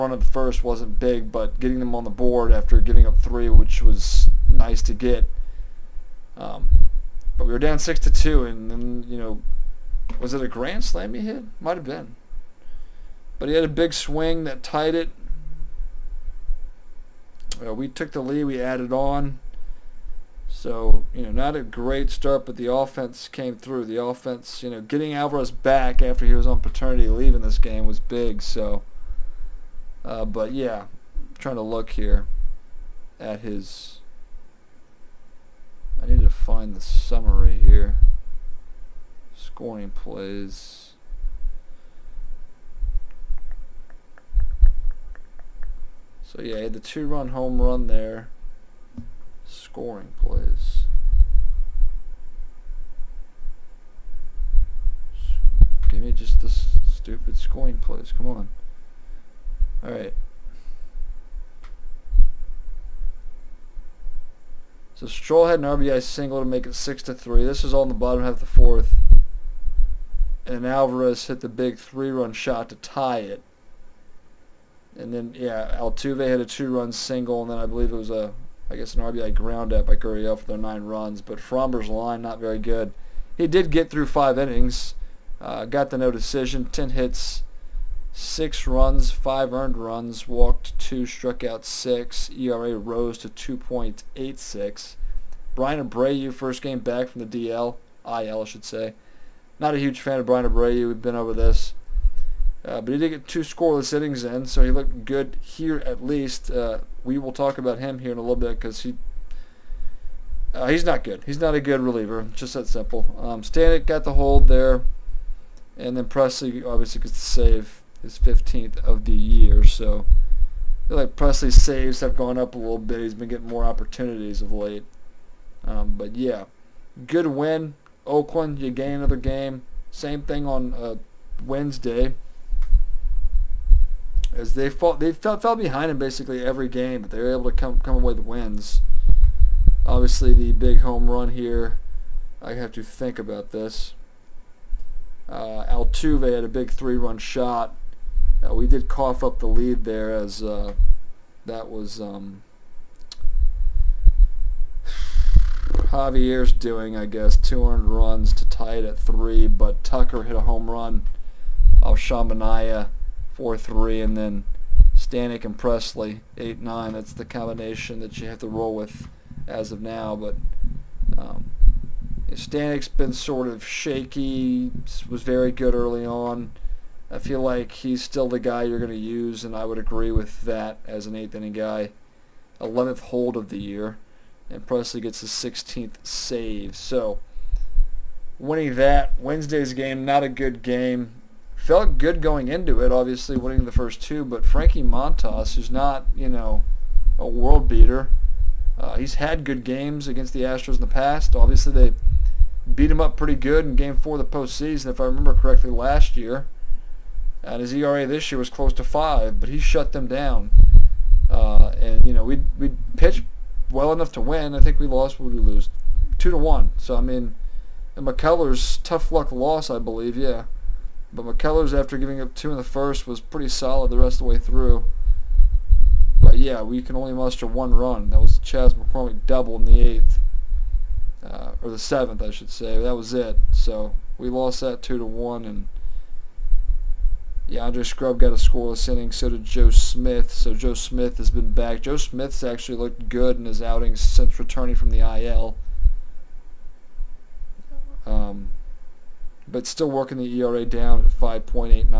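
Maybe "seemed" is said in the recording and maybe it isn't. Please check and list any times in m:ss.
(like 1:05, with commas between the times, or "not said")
not said.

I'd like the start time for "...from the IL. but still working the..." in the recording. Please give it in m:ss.
4:04.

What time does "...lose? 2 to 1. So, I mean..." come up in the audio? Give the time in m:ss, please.
3:35.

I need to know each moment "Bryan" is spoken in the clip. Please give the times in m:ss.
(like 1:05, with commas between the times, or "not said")
1:35, 1:40.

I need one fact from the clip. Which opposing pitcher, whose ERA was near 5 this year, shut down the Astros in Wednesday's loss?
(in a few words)
Frankie Montas.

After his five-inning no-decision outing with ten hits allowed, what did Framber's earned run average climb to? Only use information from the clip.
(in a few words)
2.86.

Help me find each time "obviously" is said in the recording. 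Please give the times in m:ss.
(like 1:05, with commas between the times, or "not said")
1:56, 2:19, 3:12, 3:21.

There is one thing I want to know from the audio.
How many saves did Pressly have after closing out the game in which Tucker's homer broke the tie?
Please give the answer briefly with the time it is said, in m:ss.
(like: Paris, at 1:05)
16, at 3:05.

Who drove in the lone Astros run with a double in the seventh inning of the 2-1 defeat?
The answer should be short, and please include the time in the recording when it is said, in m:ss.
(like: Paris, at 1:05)
Chas McCormick, at 3:48.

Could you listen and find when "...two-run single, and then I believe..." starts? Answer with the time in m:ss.
1:16.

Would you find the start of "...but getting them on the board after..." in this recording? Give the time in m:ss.
0:01.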